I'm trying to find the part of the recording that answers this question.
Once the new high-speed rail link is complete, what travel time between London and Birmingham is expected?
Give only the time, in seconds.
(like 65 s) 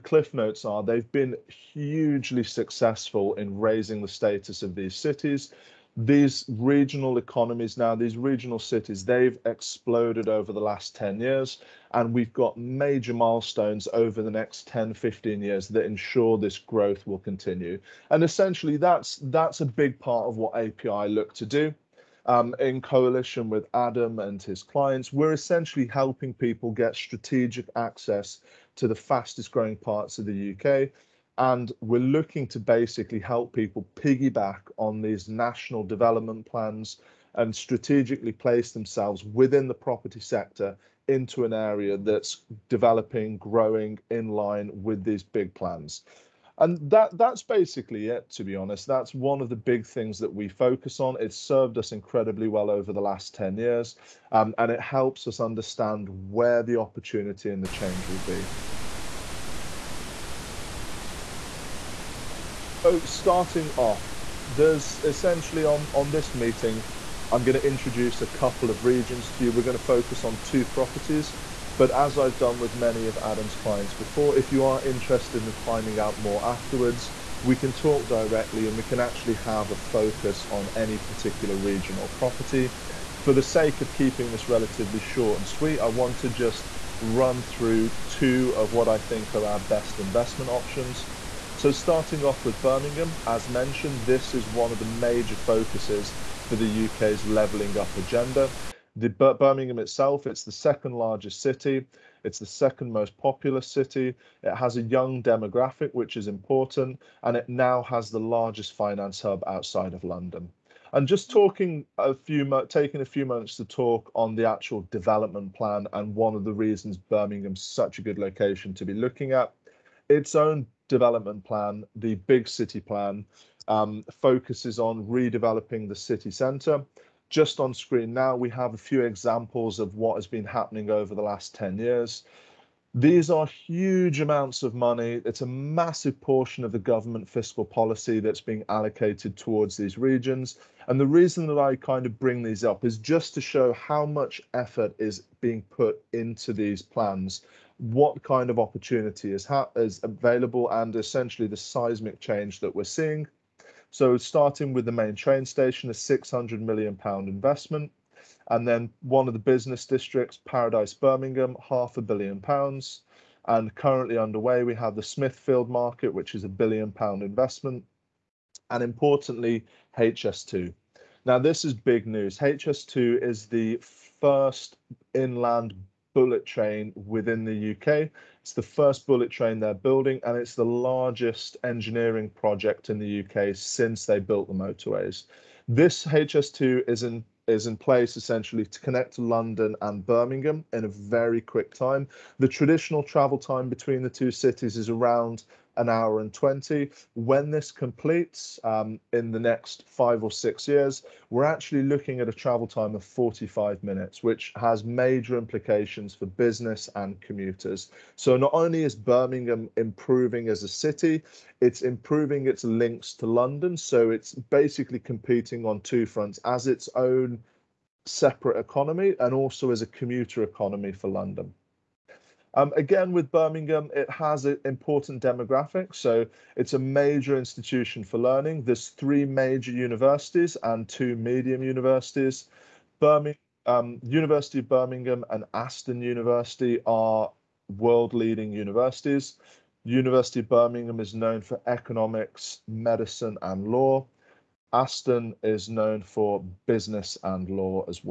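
203 s.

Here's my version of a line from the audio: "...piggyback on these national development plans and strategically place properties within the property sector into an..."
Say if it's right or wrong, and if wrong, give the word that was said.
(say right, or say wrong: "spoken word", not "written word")
wrong: "themselves", not "properties".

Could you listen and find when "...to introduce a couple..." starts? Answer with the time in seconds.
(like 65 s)
67 s.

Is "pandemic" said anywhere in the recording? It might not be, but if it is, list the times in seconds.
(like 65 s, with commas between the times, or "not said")
not said.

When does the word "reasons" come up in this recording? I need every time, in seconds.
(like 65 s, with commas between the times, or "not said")
116 s, 141 s.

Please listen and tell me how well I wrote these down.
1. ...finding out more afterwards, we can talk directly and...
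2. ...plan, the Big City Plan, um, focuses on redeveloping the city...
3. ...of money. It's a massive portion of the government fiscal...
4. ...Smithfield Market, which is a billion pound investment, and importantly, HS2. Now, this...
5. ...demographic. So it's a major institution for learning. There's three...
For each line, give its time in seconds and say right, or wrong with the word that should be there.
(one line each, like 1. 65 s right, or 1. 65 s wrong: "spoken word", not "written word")
1. 75 s right
2. 121 s right
3. 134 s right
4. 165 s right
5. 225 s right.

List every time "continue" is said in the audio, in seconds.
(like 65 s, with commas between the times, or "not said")
17 s.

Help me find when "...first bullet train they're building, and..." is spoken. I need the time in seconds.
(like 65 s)
178 s.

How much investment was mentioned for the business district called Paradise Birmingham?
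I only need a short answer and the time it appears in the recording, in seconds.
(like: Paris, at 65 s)
Half a billion pounds, at 161 s.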